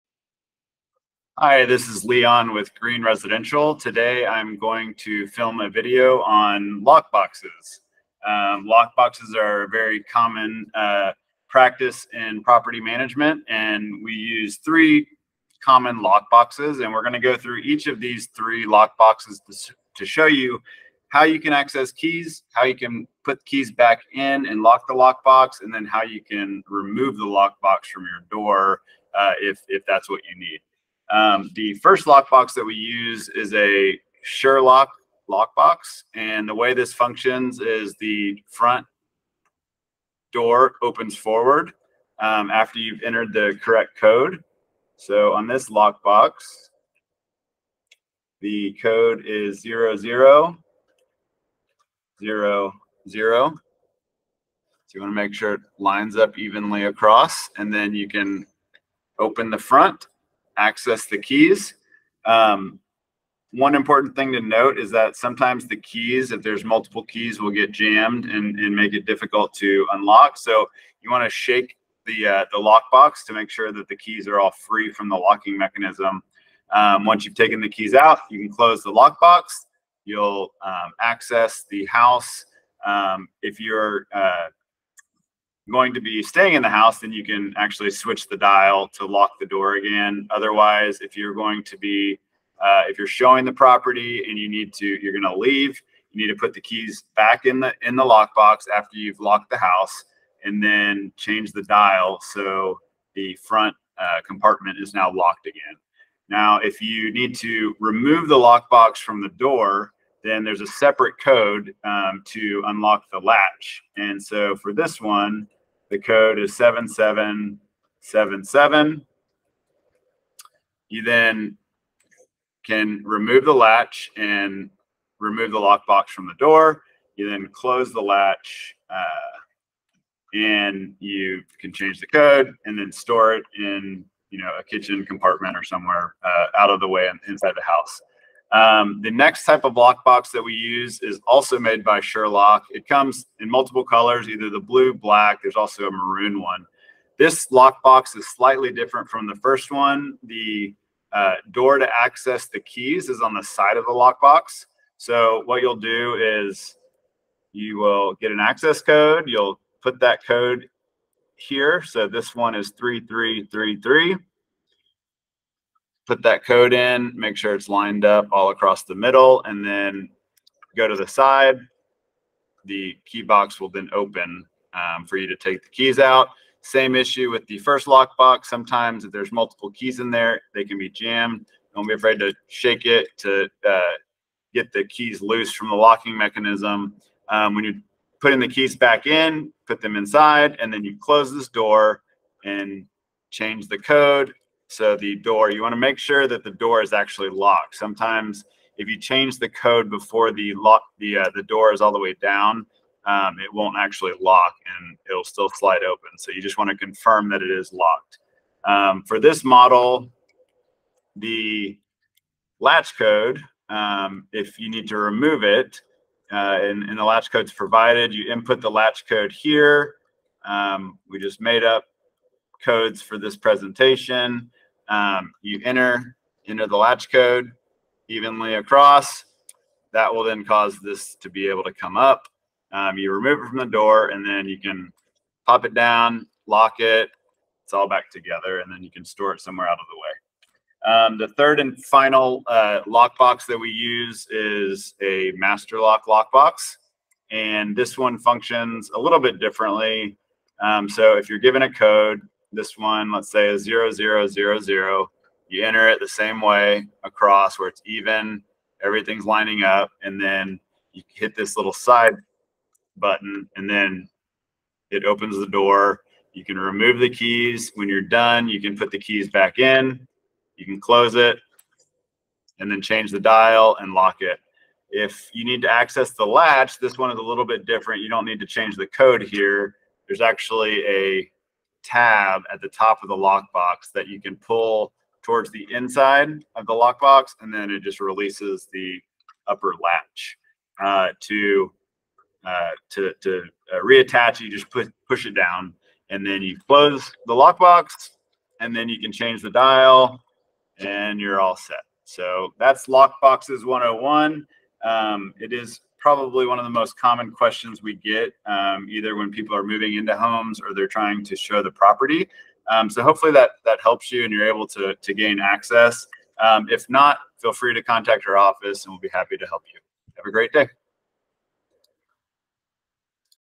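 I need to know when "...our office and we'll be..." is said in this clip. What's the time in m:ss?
5:18.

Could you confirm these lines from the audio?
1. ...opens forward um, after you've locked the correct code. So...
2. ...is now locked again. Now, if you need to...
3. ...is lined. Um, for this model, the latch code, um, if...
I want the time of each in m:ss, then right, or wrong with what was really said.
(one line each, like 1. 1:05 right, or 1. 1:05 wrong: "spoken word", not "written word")
1. 0:40 wrong: "entered", not "locked"
2. 1:44 right
3. 3:27 wrong: "locked", not "lined".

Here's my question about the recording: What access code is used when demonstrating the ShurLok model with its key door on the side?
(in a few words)
3333.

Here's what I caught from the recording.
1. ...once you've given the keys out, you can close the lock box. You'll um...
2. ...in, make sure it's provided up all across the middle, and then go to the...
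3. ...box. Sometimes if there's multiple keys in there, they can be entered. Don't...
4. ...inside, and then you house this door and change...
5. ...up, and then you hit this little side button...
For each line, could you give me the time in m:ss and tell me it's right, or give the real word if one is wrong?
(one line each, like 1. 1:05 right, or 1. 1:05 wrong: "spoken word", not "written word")
1. 1:17 wrong: "taken", not "given"
2. 2:46 wrong: "lined", not "provided"
3. 2:58 wrong: "jammed", not "entered"
4. 3:09 wrong: "close", not "house"
5. 4:19 right.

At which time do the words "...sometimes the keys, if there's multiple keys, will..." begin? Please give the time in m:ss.
1:05.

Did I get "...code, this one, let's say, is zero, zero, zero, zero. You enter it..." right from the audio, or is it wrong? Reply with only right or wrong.
right.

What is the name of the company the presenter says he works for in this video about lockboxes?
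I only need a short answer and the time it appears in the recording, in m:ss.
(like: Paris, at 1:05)
Green Residential, at 0:02.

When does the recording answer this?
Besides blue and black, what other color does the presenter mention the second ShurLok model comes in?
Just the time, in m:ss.
2:25.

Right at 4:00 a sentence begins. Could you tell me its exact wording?
Um, the third and final uh, lockbox that we use is a master lock lockbox.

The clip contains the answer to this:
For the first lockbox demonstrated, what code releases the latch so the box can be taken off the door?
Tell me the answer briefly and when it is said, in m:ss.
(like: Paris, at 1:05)
7777, at 1:56.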